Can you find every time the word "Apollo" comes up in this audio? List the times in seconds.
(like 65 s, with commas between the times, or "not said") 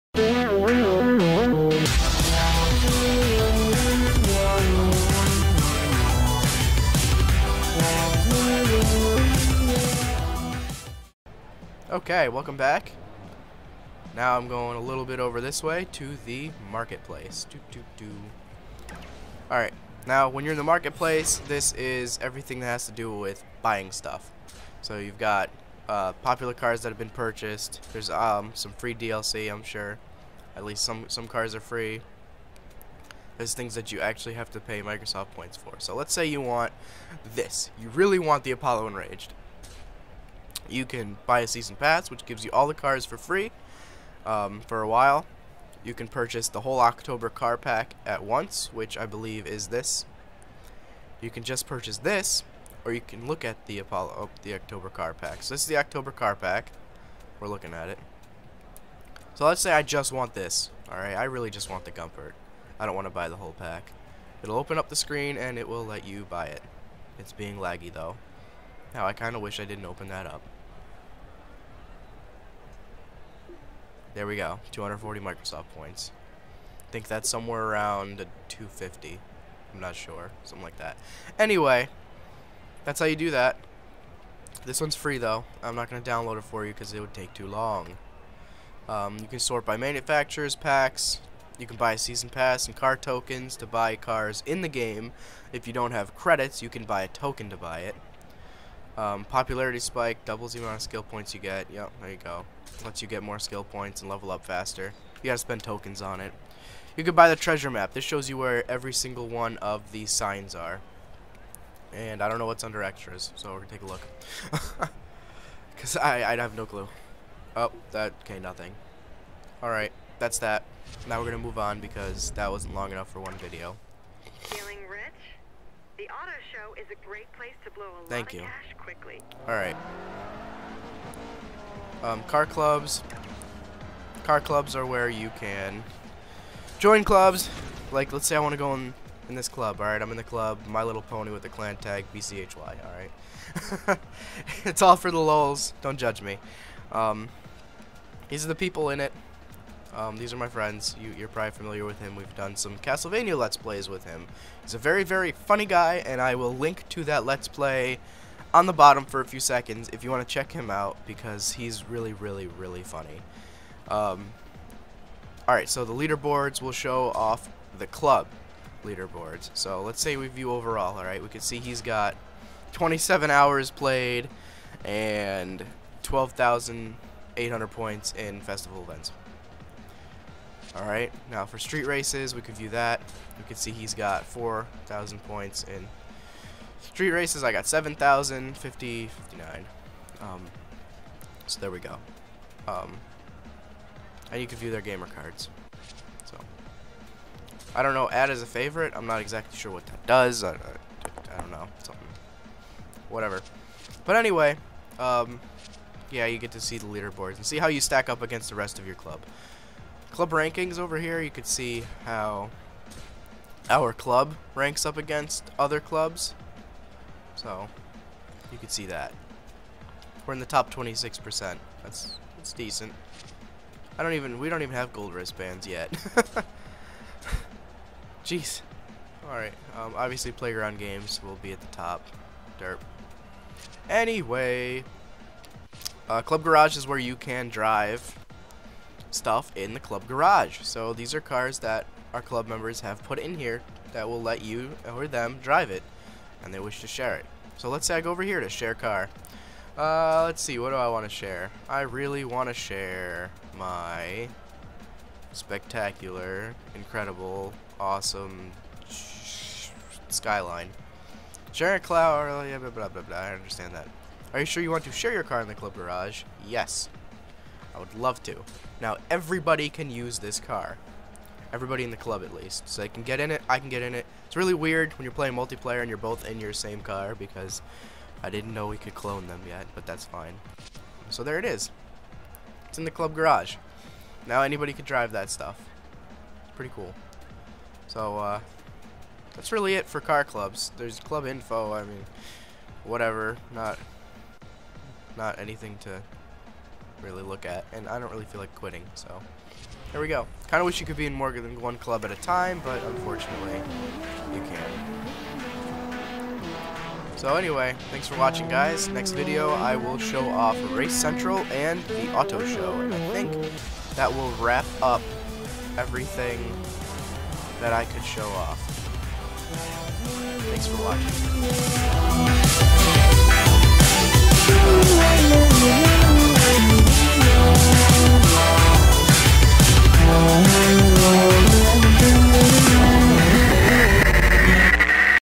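38 s, 53 s.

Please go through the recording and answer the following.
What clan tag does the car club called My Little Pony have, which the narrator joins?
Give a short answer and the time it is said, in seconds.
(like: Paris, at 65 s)
BCHY, at 142 s.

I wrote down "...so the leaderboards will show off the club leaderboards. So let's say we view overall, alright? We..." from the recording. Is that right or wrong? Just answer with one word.
right.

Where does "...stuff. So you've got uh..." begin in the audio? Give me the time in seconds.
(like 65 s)
23 s.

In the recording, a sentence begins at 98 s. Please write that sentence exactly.
Um, popularity spike doubles the amount of skill points you get.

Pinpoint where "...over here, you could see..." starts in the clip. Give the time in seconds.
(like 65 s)
210 s.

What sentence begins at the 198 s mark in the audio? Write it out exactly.
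I'm not exactly sure what that does.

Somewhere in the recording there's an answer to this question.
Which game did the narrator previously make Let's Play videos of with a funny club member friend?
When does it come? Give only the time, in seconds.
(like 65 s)
152 s.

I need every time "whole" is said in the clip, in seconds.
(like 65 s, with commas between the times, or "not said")
46 s, 63 s.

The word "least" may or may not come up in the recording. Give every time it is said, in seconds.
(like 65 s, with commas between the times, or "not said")
30 s, 272 s.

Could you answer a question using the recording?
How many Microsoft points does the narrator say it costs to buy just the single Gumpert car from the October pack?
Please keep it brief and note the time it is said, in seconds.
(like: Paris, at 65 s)
240, at 74 s.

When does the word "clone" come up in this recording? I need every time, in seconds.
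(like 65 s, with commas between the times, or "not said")
278 s.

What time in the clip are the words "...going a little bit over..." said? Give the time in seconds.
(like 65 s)
14 s.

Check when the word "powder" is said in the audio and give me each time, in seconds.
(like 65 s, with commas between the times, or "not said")
not said.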